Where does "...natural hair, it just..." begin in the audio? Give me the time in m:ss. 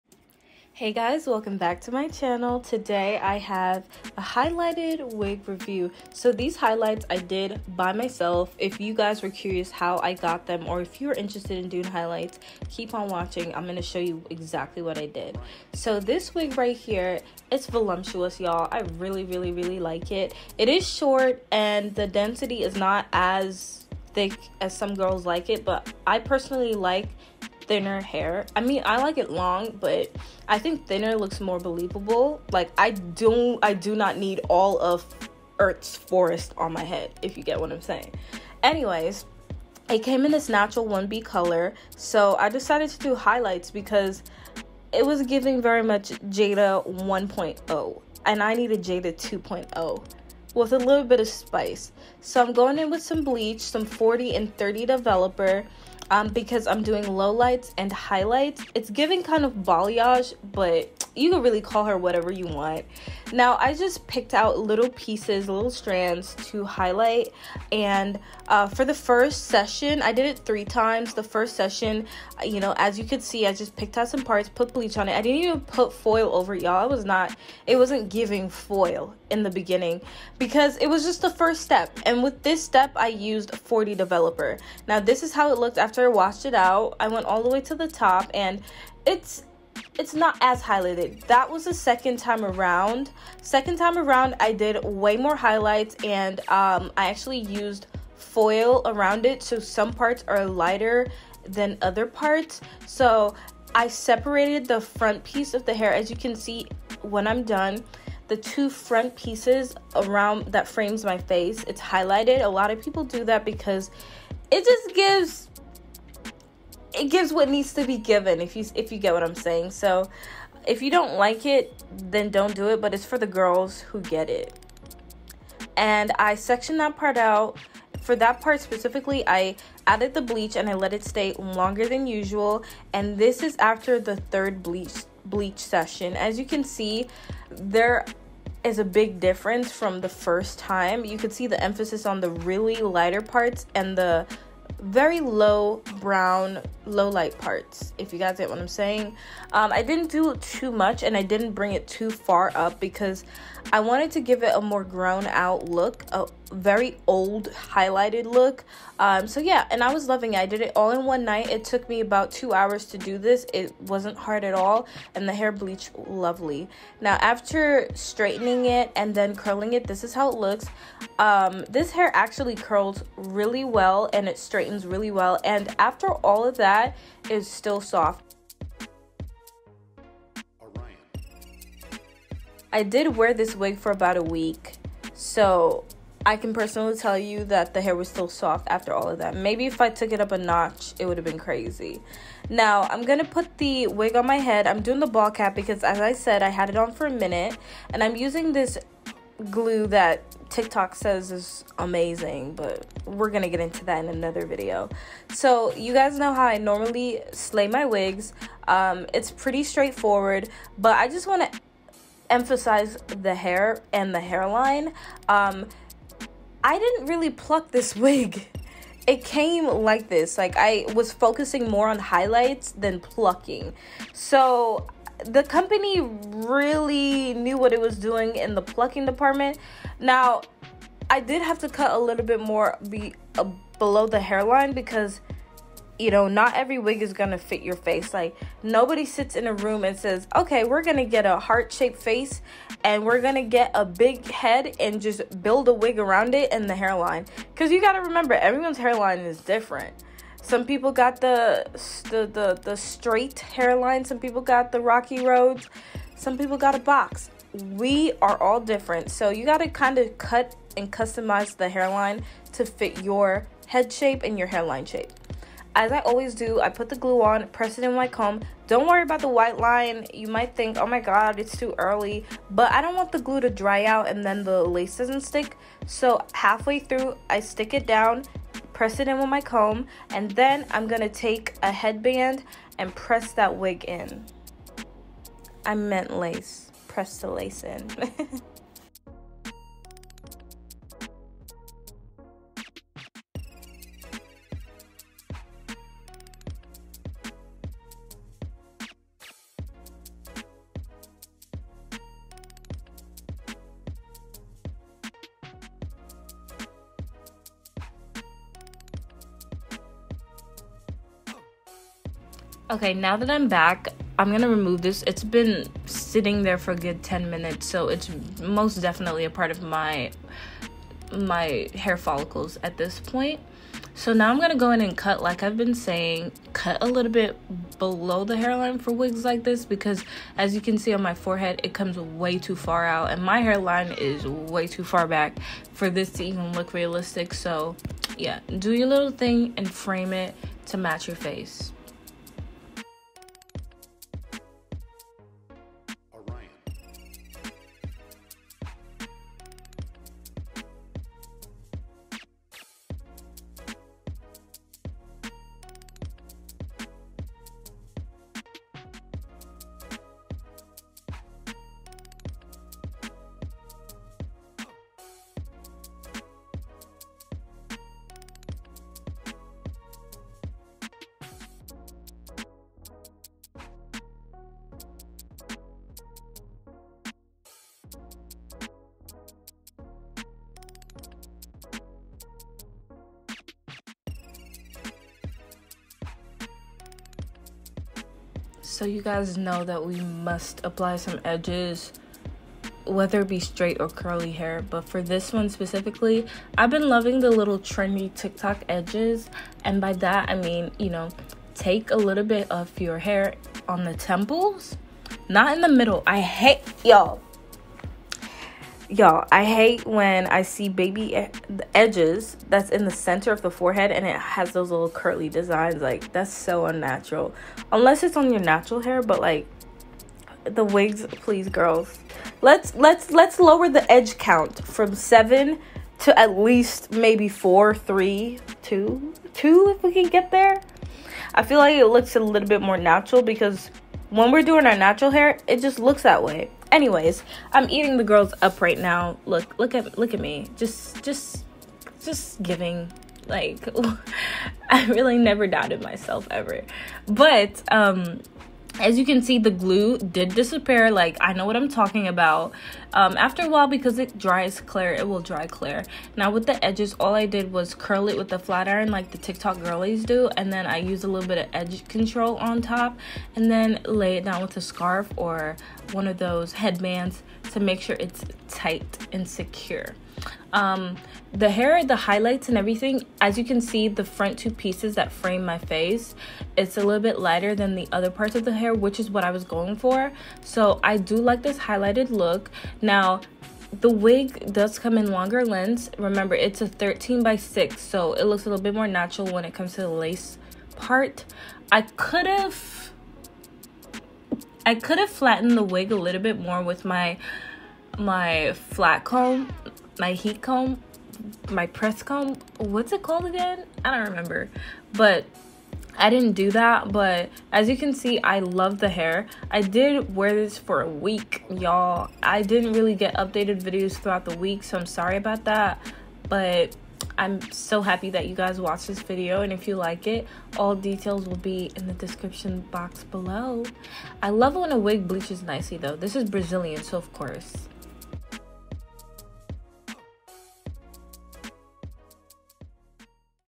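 7:14.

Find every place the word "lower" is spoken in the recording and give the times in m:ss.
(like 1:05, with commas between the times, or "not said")
7:03.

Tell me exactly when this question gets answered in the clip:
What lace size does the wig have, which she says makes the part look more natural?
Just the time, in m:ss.
8:06.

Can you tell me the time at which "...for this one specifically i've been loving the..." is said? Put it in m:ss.
6:34.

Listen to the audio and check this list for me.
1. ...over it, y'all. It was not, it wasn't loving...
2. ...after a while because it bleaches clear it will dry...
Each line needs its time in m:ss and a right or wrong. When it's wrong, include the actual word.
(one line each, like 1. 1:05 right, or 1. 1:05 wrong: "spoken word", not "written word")
1. 1:16 wrong: "giving", not "loving"
2. 7:33 wrong: "dries", not "bleaches".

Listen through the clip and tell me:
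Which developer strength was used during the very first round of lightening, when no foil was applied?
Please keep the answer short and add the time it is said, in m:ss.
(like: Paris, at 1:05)
40, at 1:23.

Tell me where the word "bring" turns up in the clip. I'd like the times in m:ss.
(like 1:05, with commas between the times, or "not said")
2:31.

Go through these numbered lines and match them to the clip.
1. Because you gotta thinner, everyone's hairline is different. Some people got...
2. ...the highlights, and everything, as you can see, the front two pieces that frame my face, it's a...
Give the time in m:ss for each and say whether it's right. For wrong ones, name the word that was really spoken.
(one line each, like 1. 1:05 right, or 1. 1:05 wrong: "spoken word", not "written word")
1. 4:07 wrong: "remember", not "thinner"
2. 7:51 right.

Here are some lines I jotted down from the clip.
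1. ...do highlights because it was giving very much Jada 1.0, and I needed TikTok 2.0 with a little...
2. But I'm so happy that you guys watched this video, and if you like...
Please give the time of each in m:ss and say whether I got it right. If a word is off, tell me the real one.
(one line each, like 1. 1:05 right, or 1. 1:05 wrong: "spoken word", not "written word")
1. 0:42 wrong: "Jada", not "TikTok"
2. 8:36 right.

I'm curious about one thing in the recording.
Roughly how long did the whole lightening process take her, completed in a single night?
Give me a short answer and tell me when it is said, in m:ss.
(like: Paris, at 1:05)
2 hours, at 2:42.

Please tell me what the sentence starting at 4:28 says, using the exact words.
Don't worry about the white line.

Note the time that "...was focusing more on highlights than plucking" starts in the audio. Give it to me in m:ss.
3:40.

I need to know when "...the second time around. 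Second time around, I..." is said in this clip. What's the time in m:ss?
1:31.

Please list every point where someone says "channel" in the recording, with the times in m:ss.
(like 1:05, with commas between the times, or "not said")
0:02.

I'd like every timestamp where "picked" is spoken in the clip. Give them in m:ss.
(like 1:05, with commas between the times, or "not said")
1:04, 1:13.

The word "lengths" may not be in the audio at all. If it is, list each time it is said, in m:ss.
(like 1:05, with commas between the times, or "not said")
8:05.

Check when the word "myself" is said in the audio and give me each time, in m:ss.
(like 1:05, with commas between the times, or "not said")
0:07, 7:25.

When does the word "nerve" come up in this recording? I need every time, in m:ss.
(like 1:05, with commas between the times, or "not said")
not said.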